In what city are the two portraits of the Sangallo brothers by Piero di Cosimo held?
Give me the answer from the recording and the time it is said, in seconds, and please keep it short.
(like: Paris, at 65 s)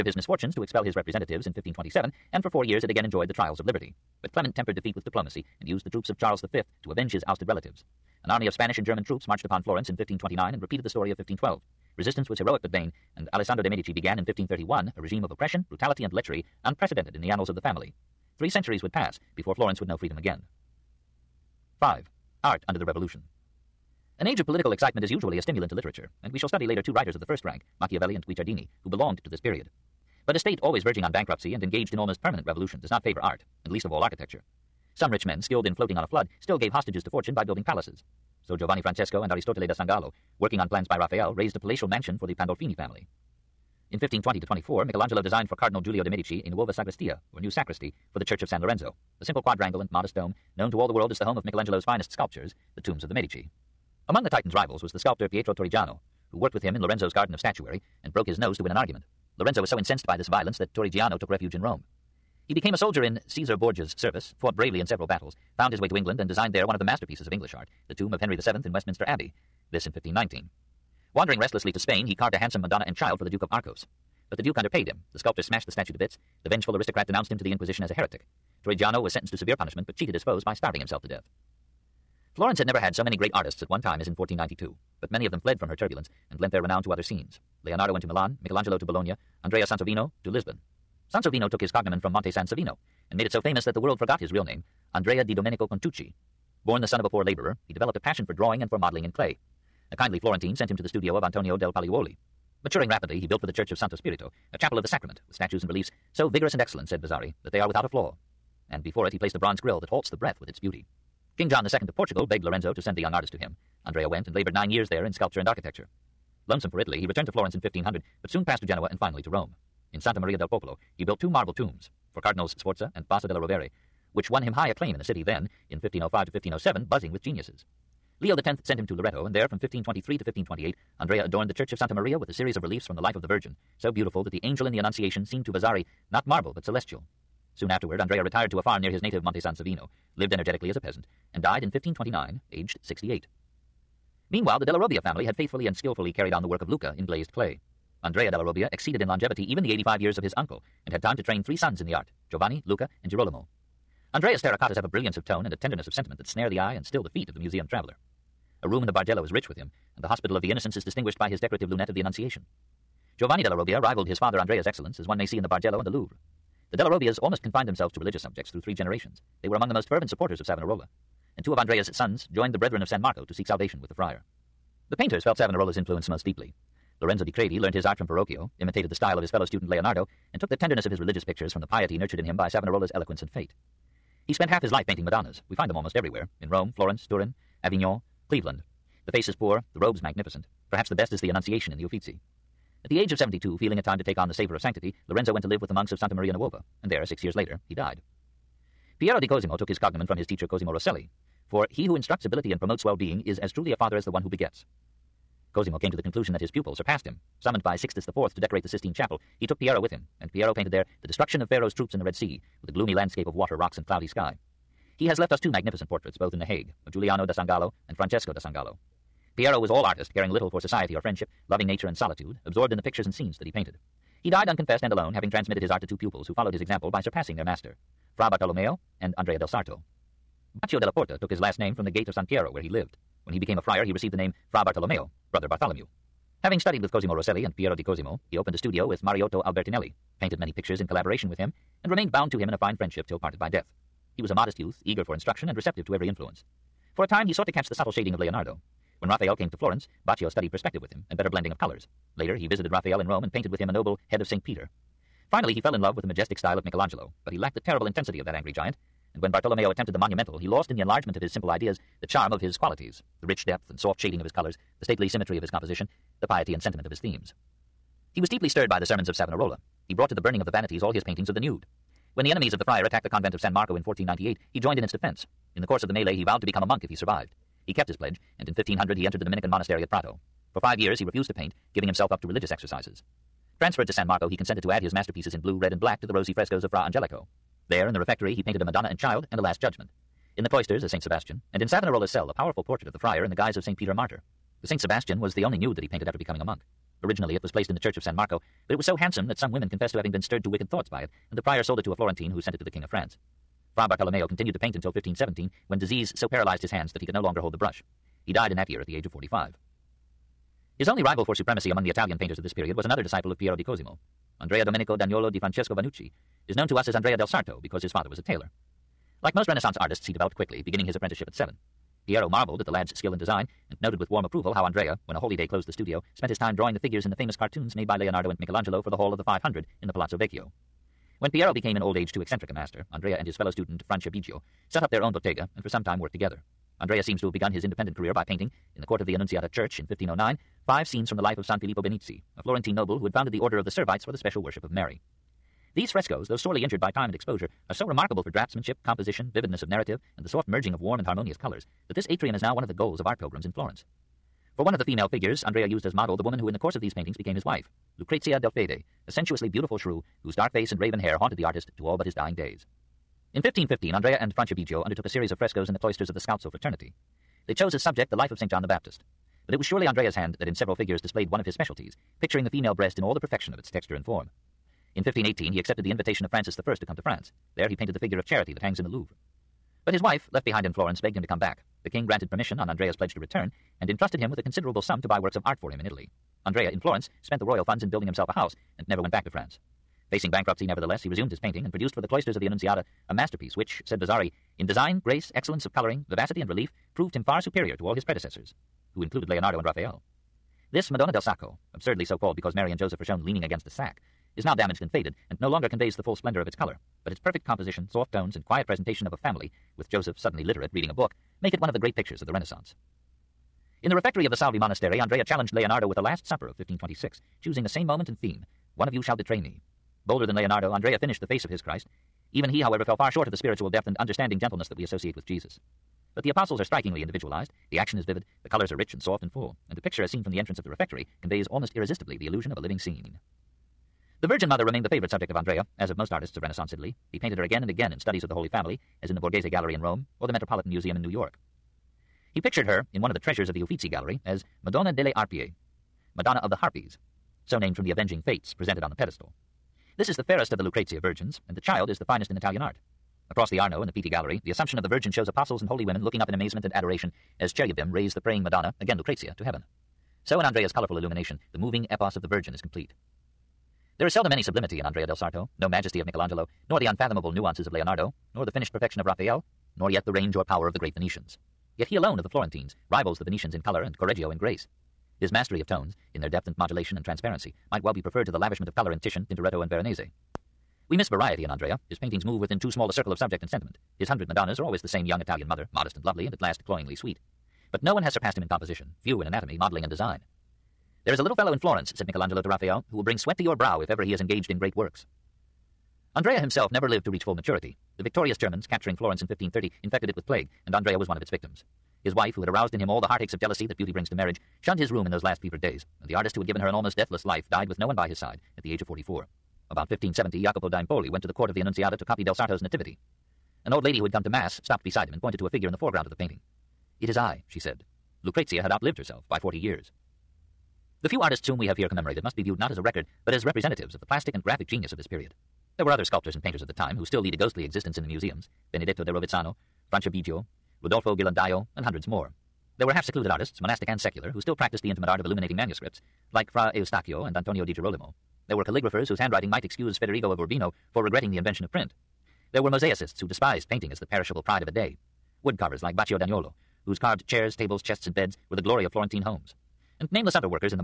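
The Hague, at 216 s.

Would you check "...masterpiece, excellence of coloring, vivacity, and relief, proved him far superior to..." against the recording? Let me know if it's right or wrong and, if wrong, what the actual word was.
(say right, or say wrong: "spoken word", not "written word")
wrong: "grace", not "masterpiece".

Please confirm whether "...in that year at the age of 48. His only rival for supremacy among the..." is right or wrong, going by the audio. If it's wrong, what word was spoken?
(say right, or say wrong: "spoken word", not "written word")
wrong: "45", not "48".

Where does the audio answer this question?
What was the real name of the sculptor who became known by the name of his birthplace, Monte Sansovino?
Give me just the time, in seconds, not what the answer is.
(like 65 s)
94 s.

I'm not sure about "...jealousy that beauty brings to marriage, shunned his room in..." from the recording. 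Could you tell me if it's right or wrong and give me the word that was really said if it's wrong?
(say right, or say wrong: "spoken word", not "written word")
right.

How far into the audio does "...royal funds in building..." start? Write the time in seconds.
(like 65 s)
387 s.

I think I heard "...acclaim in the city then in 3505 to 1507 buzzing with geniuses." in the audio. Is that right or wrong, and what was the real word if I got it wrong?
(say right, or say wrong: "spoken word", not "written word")
wrong: "1505", not "3505".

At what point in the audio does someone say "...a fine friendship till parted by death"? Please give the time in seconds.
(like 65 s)
242 s.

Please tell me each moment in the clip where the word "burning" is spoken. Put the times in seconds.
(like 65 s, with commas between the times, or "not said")
270 s.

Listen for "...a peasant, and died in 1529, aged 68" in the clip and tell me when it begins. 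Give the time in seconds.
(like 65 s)
140 s.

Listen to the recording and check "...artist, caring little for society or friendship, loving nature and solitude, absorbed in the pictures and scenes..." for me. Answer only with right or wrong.
right.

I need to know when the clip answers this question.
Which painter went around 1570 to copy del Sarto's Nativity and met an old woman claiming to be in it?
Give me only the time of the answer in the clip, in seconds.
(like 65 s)
510 s.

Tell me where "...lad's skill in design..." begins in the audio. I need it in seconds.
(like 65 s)
322 s.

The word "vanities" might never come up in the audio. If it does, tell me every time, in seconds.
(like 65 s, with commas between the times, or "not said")
270 s.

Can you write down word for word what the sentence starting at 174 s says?
The painters felt Savonarola's influence most deeply.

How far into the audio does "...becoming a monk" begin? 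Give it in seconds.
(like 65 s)
296 s.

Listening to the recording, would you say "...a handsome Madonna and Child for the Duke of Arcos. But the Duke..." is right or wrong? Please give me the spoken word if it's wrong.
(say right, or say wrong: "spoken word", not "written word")
right.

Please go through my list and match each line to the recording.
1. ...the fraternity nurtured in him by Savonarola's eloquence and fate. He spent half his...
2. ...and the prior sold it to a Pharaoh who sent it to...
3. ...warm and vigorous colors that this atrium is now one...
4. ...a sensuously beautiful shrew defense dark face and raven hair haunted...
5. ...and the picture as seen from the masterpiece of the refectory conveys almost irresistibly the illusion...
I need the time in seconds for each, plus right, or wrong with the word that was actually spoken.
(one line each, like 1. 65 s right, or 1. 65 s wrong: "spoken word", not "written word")
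1. 181 s wrong: "piety", not "fraternity"
2. 301 s wrong: "Florentine", not "Pharaoh"
3. 350 s wrong: "harmonious", not "vigorous"
4. 359 s wrong: "whose", not "defense"
5. 429 s wrong: "entrance", not "masterpiece".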